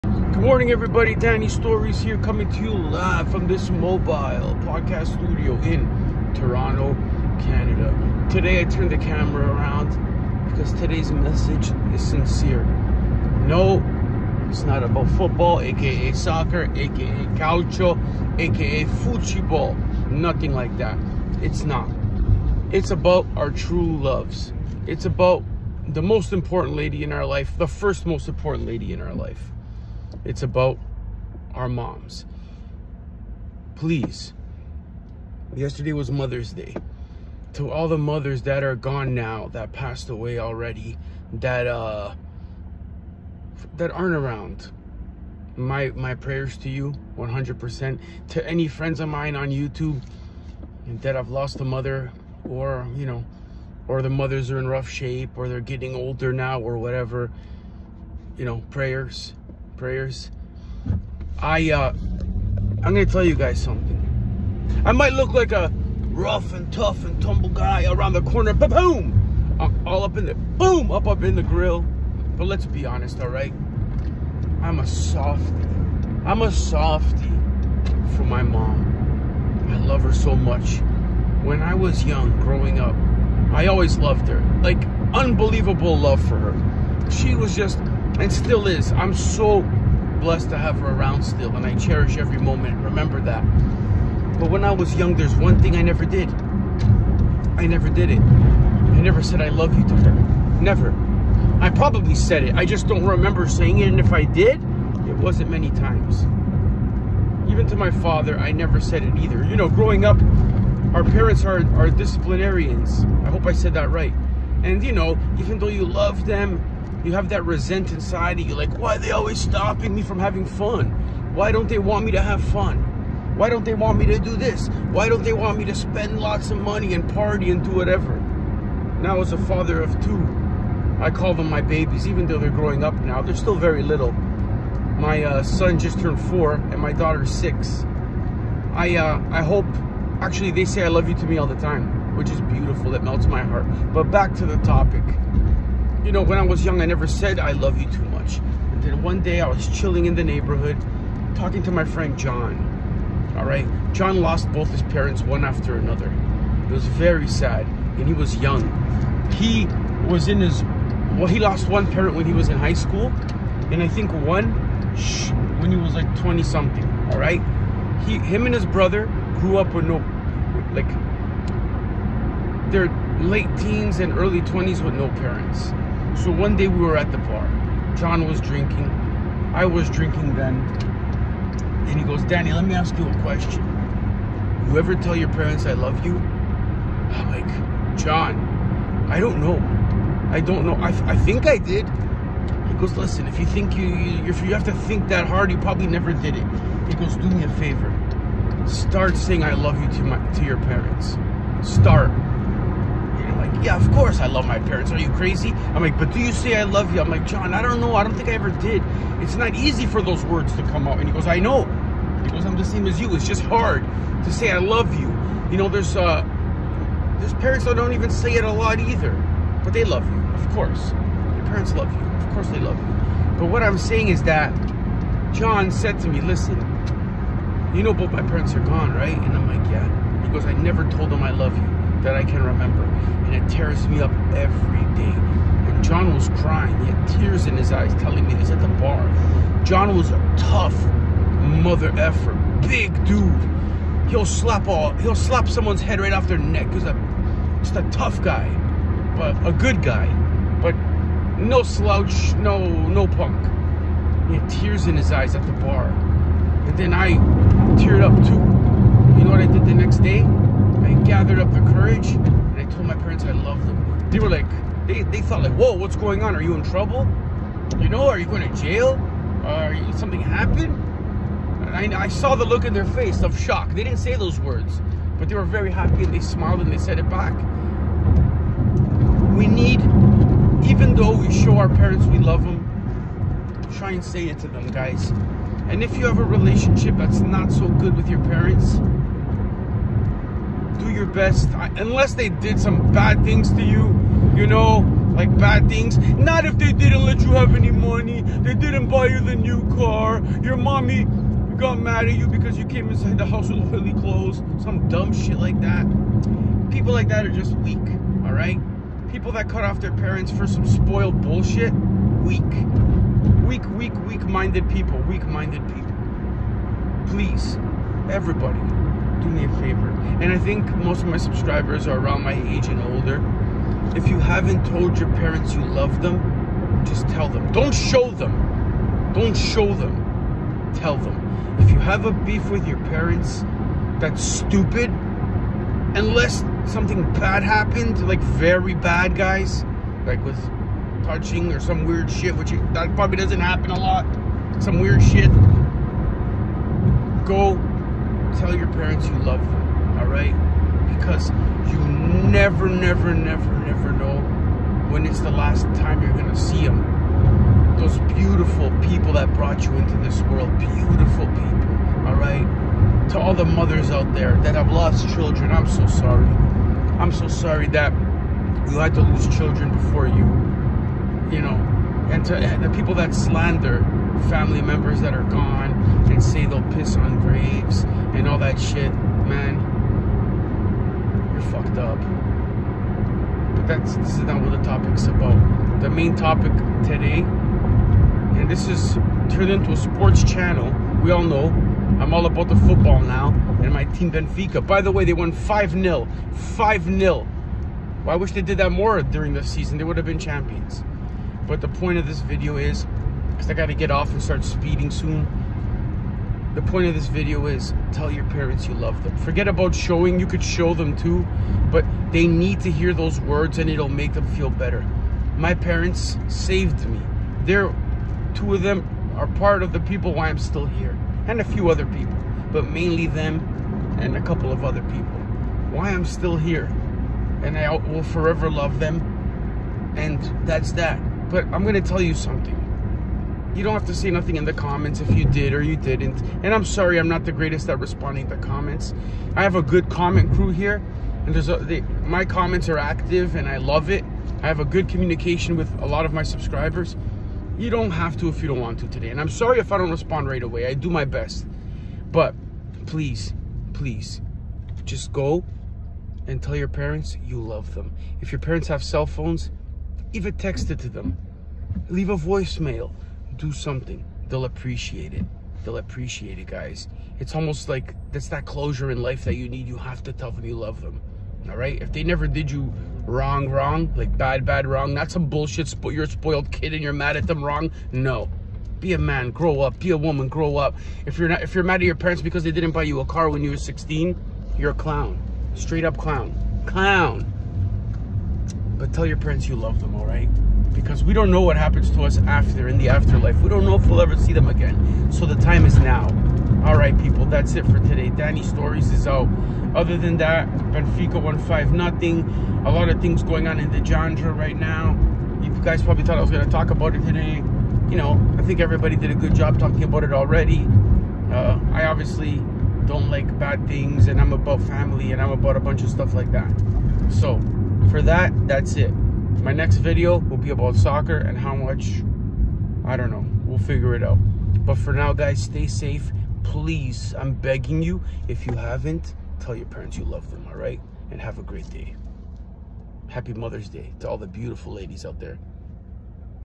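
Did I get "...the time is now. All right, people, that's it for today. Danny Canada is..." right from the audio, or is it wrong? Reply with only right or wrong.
wrong.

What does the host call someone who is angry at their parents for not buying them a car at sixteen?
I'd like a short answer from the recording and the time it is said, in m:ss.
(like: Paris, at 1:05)
A clown, at 8:04.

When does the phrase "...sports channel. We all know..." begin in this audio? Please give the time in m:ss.
6:29.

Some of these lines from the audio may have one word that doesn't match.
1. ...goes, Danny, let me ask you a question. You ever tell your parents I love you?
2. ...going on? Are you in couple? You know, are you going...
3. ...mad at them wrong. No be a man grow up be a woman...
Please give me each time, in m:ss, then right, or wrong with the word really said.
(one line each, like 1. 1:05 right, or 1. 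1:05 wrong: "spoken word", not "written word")
1. 3:02 right
2. 4:25 wrong: "trouble", not "couple"
3. 7:56 right.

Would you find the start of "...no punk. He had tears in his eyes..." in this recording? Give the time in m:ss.
4:12.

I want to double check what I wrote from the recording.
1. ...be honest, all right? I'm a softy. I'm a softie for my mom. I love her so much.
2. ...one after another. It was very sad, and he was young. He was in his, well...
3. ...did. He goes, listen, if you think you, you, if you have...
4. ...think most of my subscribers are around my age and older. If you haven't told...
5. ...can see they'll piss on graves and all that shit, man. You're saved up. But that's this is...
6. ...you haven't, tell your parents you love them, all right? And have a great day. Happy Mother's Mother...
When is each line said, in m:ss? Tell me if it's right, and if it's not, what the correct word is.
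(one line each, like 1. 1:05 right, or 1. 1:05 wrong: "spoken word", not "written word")
1. 1:12 right
2. 2:35 right
3. 3:11 right
4. 5:20 right
5. 6:16 wrong: "fucked", not "saved"
6. 8:48 wrong: "Day", not "Mother".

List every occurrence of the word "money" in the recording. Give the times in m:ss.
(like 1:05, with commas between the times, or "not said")
2:06, 4:57.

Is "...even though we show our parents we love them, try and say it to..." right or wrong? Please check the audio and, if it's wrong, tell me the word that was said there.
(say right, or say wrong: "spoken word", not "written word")
right.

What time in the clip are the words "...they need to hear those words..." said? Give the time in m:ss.
6:52.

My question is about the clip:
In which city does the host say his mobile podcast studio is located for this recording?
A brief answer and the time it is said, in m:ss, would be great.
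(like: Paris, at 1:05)
Toronto, at 0:06.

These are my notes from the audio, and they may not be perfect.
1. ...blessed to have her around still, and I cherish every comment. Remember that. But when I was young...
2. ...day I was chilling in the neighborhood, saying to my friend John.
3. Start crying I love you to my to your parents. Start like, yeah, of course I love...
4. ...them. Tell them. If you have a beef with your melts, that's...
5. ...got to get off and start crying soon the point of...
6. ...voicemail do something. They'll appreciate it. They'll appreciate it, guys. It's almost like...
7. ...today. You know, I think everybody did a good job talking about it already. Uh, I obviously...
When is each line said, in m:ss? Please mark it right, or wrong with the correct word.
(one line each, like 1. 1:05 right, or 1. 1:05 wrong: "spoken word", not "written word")
1. 1:30 wrong: "moment", not "comment"
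2. 2:29 wrong: "talking", not "saying"
3. 3:18 wrong: "saying", not "crying"
4. 5:29 wrong: "parents", not "melts"
5. 6:43 wrong: "speeding", not "crying"
6. 7:42 right
7. 8:27 right.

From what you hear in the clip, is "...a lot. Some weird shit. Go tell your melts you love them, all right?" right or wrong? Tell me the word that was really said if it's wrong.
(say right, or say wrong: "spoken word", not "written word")
wrong: "parents", not "melts".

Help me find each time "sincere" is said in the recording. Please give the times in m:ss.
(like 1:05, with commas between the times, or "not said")
0:12.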